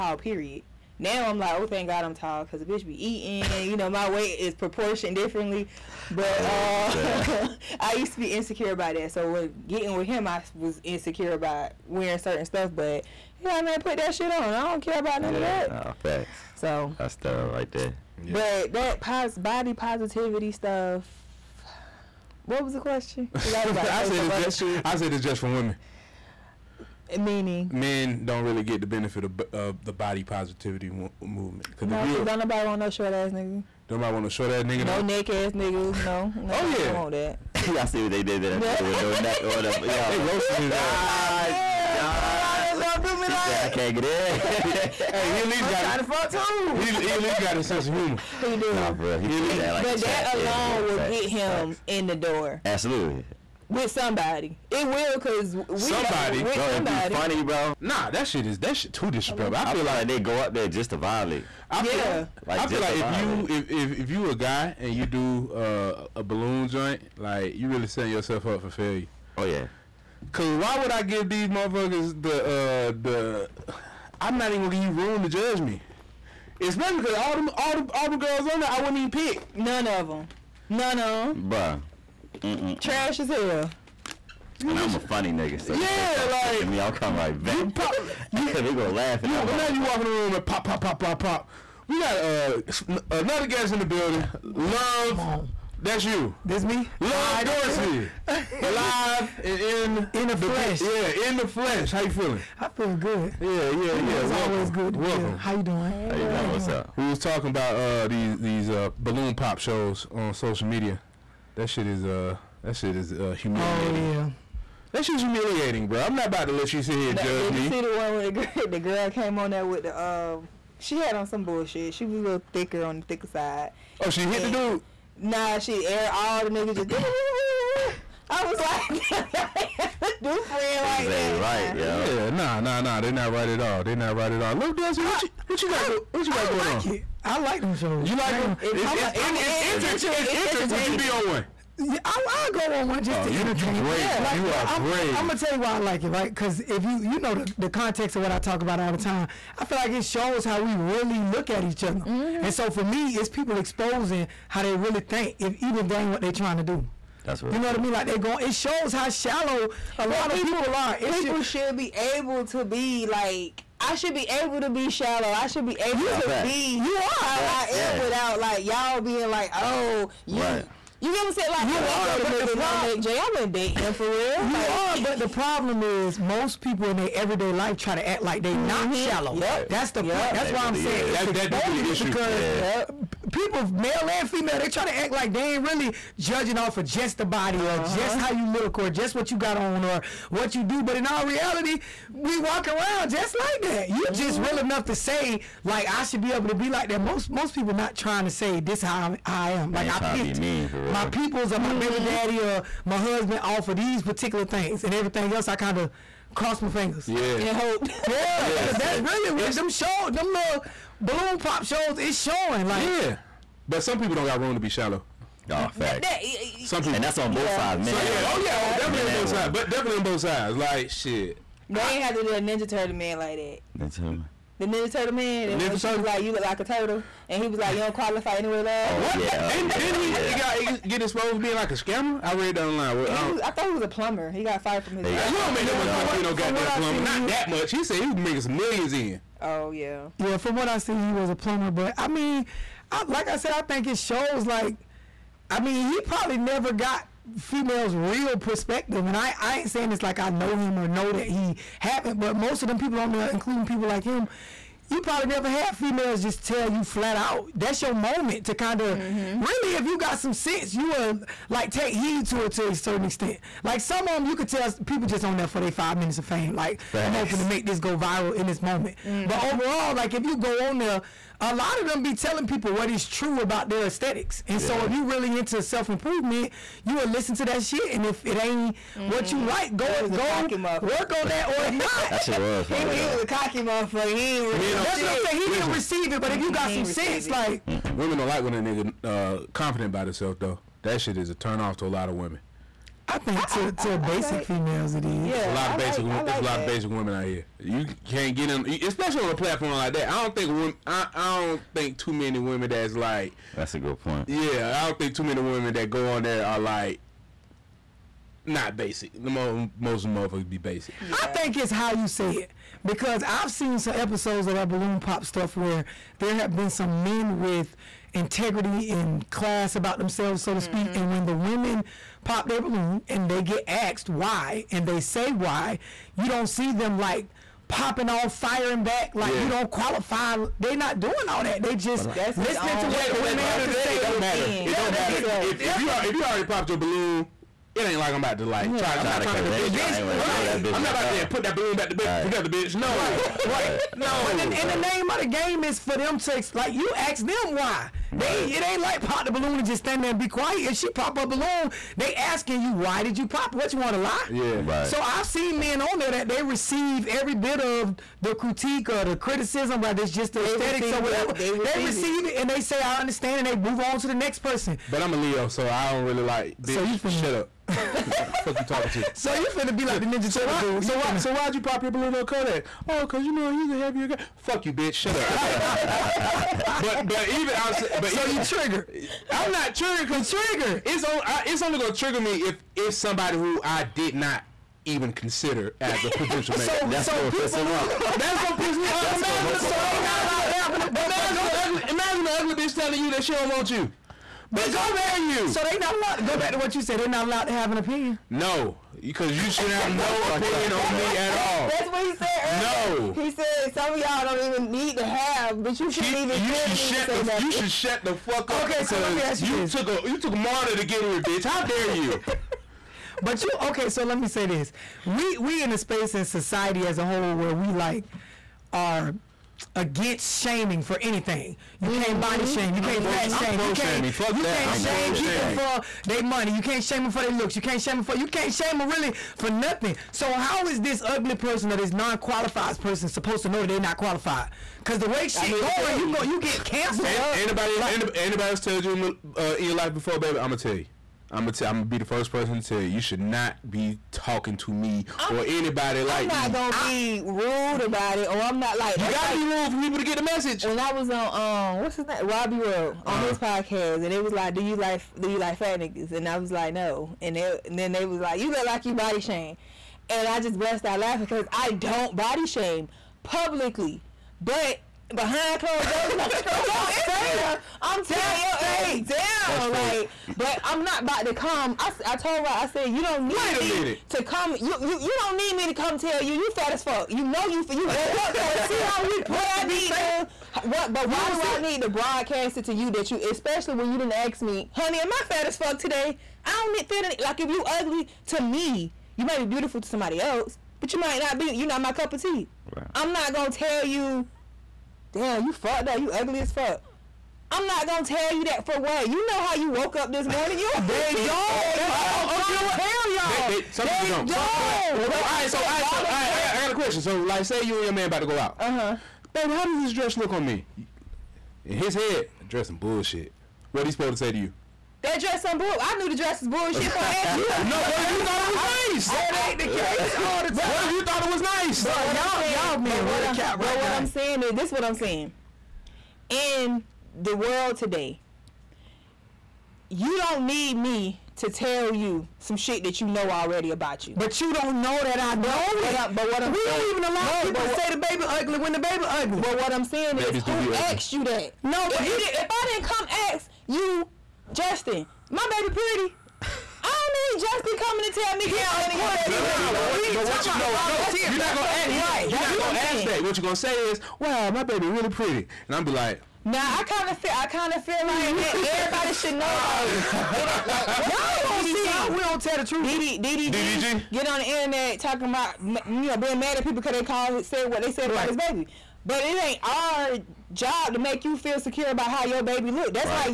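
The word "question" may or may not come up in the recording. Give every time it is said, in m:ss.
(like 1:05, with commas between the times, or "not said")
0:22, 8:26.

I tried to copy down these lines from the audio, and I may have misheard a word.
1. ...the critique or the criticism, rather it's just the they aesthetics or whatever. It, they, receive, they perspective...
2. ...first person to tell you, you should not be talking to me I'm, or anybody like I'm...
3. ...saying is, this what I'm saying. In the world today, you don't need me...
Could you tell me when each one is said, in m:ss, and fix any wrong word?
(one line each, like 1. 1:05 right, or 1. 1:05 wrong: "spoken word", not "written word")
1. 5:58 wrong: "receive", not "perspective"
2. 7:22 right
3. 8:44 right.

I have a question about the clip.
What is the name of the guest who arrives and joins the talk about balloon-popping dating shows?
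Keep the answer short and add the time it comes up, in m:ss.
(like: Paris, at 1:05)
Love Dorsey, at 1:37.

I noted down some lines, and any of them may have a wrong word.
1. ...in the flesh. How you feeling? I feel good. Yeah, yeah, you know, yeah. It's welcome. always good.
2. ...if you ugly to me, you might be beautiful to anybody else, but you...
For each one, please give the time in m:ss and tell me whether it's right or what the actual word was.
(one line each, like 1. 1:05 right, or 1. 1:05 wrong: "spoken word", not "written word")
1. 1:41 right
2. 8:07 wrong: "somebody", not "anybody".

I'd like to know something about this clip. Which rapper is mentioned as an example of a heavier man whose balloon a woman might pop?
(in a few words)
Kodak.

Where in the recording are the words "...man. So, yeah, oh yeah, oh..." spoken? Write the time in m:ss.
3:37.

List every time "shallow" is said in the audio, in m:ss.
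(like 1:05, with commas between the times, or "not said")
2:39, 2:44, 2:58, 3:34.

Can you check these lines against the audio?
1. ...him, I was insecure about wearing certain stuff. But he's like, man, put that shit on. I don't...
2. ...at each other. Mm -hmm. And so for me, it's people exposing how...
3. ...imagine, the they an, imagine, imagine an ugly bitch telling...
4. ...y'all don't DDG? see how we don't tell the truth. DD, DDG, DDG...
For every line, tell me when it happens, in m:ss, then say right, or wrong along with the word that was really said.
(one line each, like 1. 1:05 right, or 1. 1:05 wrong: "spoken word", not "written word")
1. 0:10 right
2. 2:31 right
3. 6:29 right
4. 9:21 right.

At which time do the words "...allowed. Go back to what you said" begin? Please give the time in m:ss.
6:35.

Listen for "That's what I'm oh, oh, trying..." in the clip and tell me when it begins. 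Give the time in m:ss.
8:21.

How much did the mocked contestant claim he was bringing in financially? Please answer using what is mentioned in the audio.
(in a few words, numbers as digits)
Millions.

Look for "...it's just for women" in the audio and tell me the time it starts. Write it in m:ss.
0:25.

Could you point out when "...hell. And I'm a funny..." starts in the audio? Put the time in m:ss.
1:23.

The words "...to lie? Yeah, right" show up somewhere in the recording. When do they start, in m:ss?
5:53.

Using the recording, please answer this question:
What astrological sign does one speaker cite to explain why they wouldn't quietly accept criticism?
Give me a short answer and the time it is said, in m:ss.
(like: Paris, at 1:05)
Leo, at 6:05.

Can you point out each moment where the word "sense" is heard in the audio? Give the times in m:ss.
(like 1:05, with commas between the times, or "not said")
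0:47, 4:20, 4:46.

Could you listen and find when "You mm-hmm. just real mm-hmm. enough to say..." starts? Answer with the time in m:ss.
3:13.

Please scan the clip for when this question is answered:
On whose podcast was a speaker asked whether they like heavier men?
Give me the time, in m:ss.
7:32.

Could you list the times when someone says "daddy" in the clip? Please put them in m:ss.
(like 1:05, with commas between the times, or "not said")
3:22.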